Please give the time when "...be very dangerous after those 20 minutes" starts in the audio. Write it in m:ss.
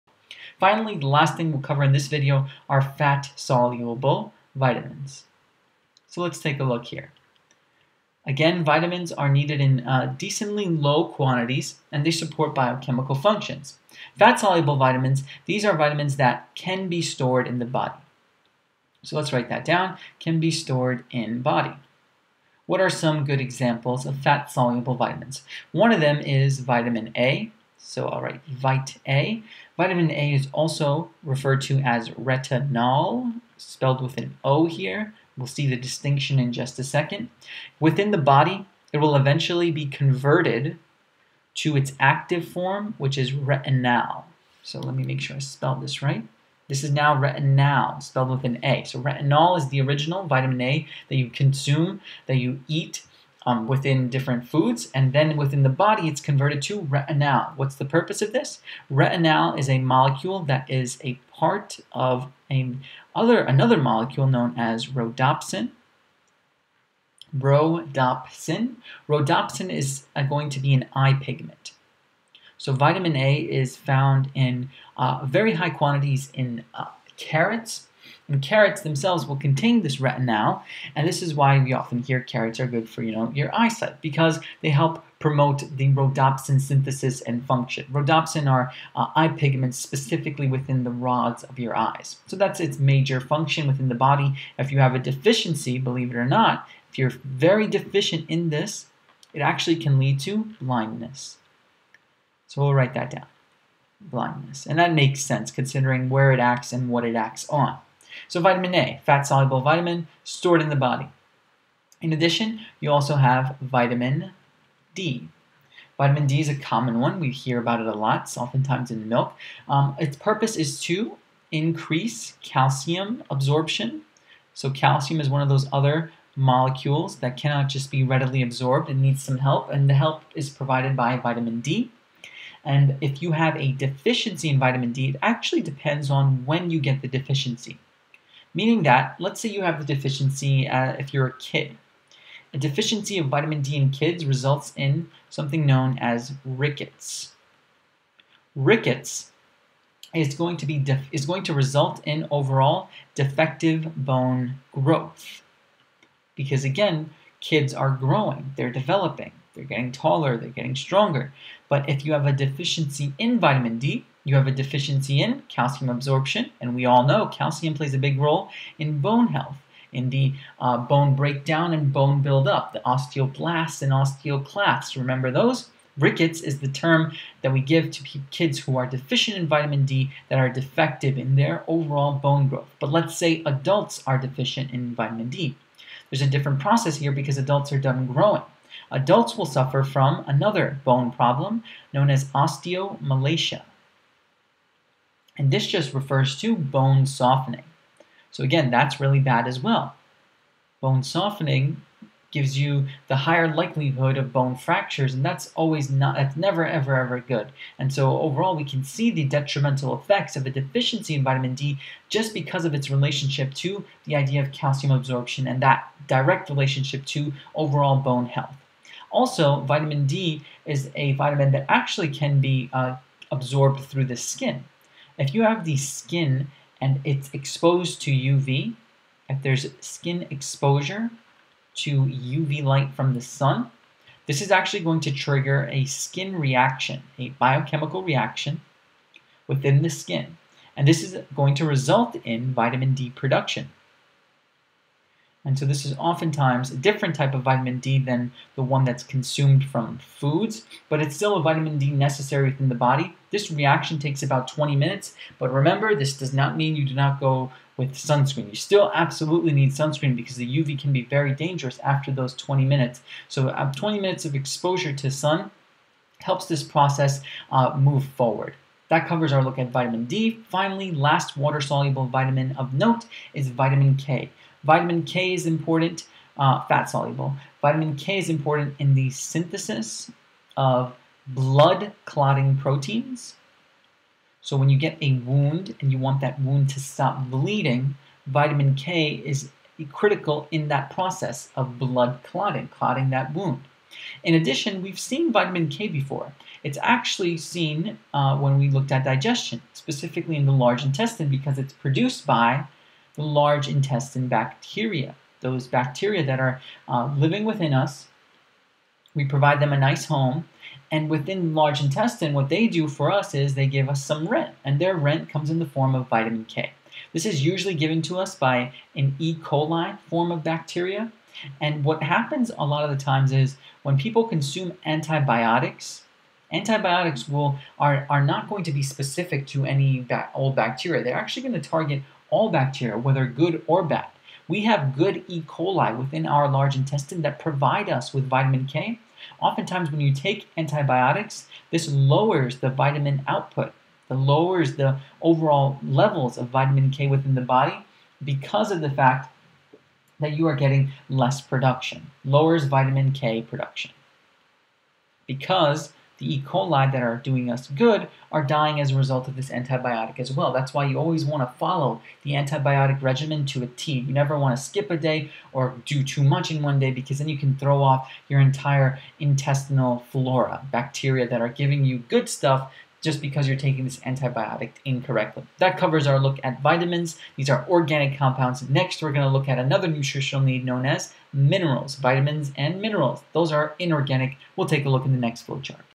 4:20.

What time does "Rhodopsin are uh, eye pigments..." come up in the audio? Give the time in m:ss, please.
1:27.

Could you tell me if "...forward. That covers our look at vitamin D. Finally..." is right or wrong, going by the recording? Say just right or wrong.
right.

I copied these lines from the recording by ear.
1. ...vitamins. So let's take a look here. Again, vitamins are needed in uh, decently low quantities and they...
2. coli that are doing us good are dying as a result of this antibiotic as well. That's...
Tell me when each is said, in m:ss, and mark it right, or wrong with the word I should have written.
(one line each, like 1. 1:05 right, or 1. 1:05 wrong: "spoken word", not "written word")
1. 0:04 right
2. 5:56 right.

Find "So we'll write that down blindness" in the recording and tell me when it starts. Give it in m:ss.
1:42.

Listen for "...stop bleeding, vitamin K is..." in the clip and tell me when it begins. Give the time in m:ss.
4:46.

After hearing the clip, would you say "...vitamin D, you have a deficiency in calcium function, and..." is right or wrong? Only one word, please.
wrong.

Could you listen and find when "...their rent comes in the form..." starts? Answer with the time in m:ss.
5:14.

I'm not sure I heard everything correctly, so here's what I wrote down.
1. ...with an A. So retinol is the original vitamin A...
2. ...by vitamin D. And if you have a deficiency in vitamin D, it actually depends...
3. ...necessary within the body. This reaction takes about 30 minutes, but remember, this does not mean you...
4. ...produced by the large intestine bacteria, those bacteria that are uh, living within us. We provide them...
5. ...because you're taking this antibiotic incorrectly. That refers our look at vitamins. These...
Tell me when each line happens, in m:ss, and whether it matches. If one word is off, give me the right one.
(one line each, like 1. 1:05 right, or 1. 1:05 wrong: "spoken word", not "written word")
1. 0:48 right
2. 2:10 right
3. 4:11 wrong: "20", not "30"
4. 5:01 right
5. 6:13 wrong: "covers", not "refers".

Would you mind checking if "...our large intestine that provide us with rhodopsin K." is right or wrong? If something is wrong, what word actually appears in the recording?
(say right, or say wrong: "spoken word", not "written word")
wrong: "vitamin", not "rhodopsin".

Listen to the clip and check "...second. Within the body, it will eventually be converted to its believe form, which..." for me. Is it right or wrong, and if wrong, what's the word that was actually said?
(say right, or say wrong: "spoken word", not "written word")
wrong: "active", not "believe".